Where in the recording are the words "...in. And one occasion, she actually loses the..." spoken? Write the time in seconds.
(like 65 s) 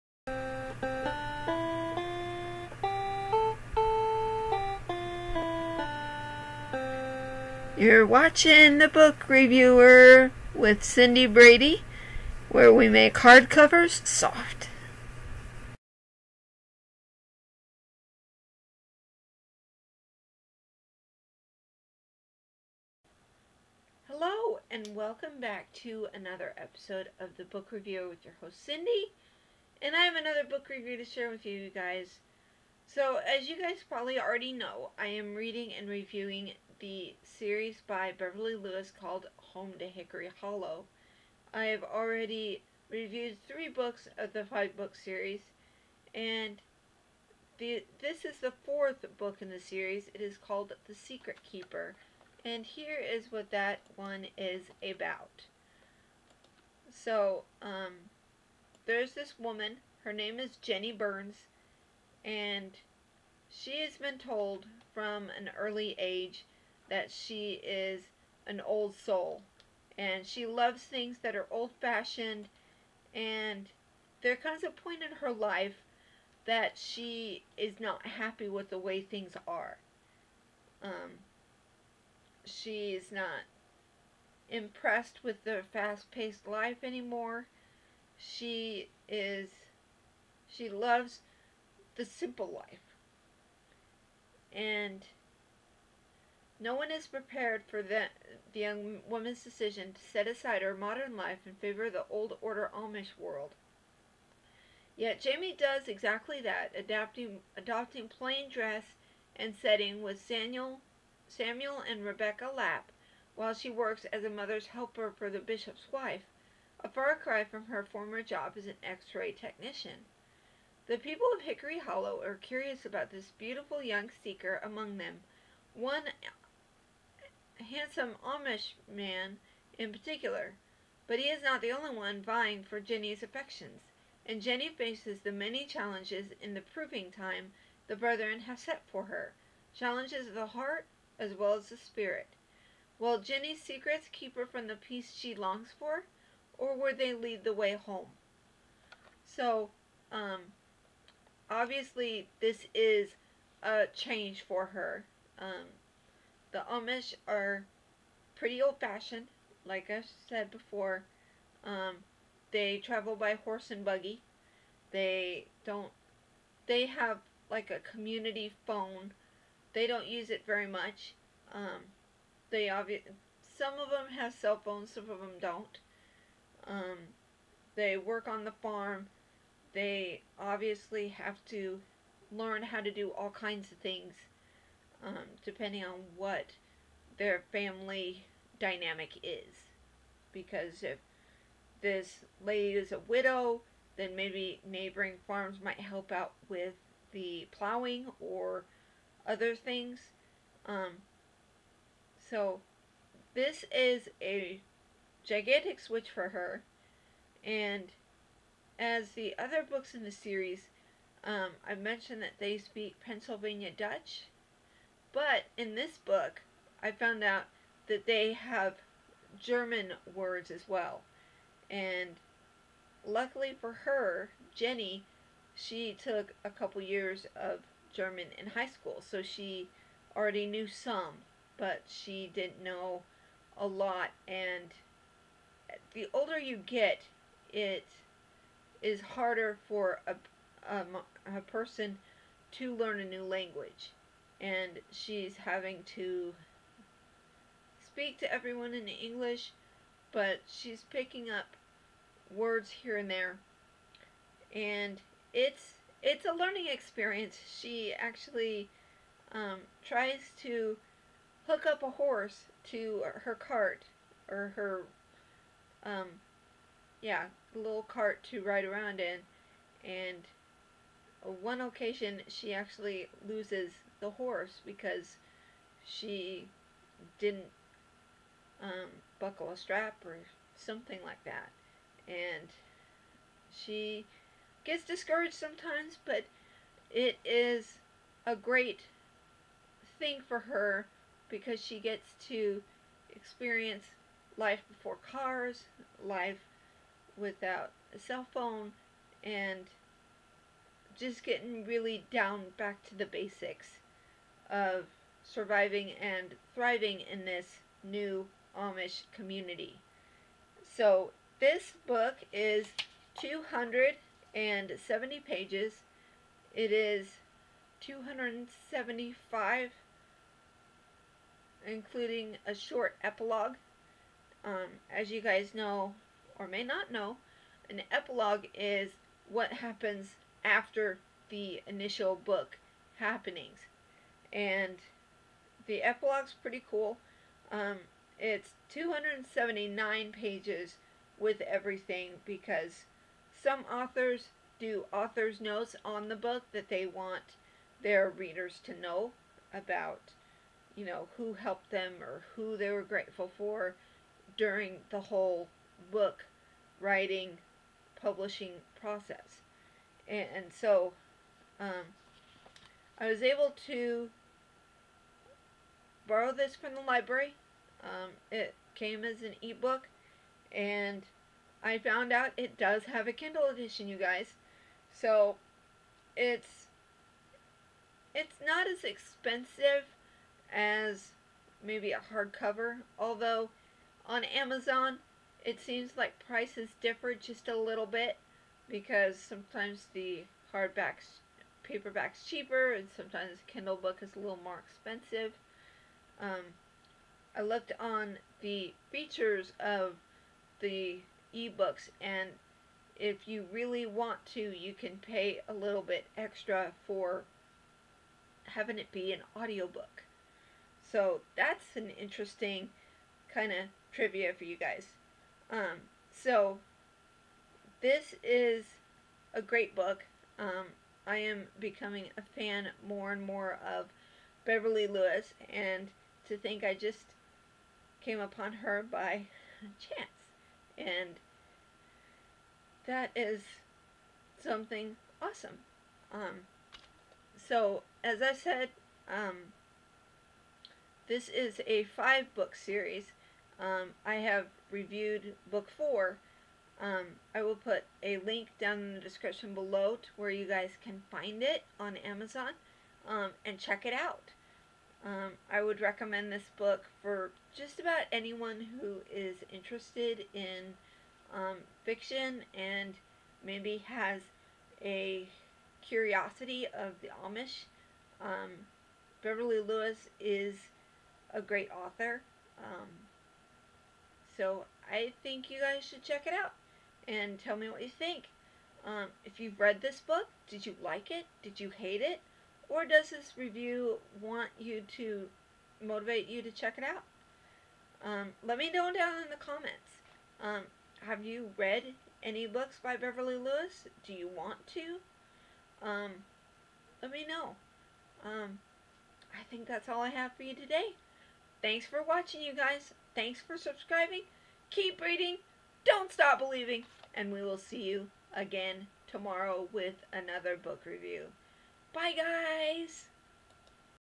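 268 s.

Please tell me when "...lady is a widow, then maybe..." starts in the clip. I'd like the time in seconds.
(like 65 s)
192 s.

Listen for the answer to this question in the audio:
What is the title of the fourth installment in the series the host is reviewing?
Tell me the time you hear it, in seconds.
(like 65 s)
50 s.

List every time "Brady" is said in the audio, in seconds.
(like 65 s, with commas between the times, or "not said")
11 s.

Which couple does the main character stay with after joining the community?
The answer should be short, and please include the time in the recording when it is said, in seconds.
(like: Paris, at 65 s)
Samuel and Rebecca Lapp, at 111 s.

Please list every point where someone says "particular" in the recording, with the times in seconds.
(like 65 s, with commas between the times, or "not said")
129 s.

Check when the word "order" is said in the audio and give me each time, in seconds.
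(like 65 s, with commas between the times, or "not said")
102 s.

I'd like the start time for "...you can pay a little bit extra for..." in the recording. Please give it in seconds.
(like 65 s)
404 s.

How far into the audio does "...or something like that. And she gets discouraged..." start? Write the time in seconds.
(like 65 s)
280 s.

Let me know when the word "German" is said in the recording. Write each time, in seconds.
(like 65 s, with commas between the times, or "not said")
219 s, 227 s.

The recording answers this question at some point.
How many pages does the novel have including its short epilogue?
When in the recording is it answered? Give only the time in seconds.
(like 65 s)
317 s.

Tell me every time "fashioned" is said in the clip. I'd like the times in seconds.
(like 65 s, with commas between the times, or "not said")
71 s, 158 s.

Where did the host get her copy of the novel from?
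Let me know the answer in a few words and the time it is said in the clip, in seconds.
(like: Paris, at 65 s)
The library, at 366 s.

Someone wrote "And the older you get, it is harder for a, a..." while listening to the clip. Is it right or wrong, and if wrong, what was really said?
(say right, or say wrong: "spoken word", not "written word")
right.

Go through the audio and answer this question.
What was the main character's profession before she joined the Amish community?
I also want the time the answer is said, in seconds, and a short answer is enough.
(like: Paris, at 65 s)
X-ray technician, at 118 s.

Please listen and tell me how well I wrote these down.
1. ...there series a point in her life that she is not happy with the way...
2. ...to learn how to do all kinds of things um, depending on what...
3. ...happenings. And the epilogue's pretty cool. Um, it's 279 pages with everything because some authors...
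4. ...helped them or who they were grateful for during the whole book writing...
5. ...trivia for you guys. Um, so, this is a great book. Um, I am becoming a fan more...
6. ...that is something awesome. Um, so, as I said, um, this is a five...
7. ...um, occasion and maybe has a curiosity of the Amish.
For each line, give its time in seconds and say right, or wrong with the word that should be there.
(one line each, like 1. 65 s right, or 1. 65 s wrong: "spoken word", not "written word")
1. 74 s wrong: "comes", not "series"
2. 181 s right
3. 332 s right
4. 351 s right
5. 413 s right
6. 432 s right
7. 461 s wrong: "fiction", not "occasion".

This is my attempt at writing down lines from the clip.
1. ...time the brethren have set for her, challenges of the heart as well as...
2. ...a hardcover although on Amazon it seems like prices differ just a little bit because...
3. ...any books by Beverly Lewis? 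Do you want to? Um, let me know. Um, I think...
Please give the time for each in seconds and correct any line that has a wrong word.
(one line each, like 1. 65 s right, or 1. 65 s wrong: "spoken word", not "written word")
1. 137 s right
2. 381 s right
3. 492 s right.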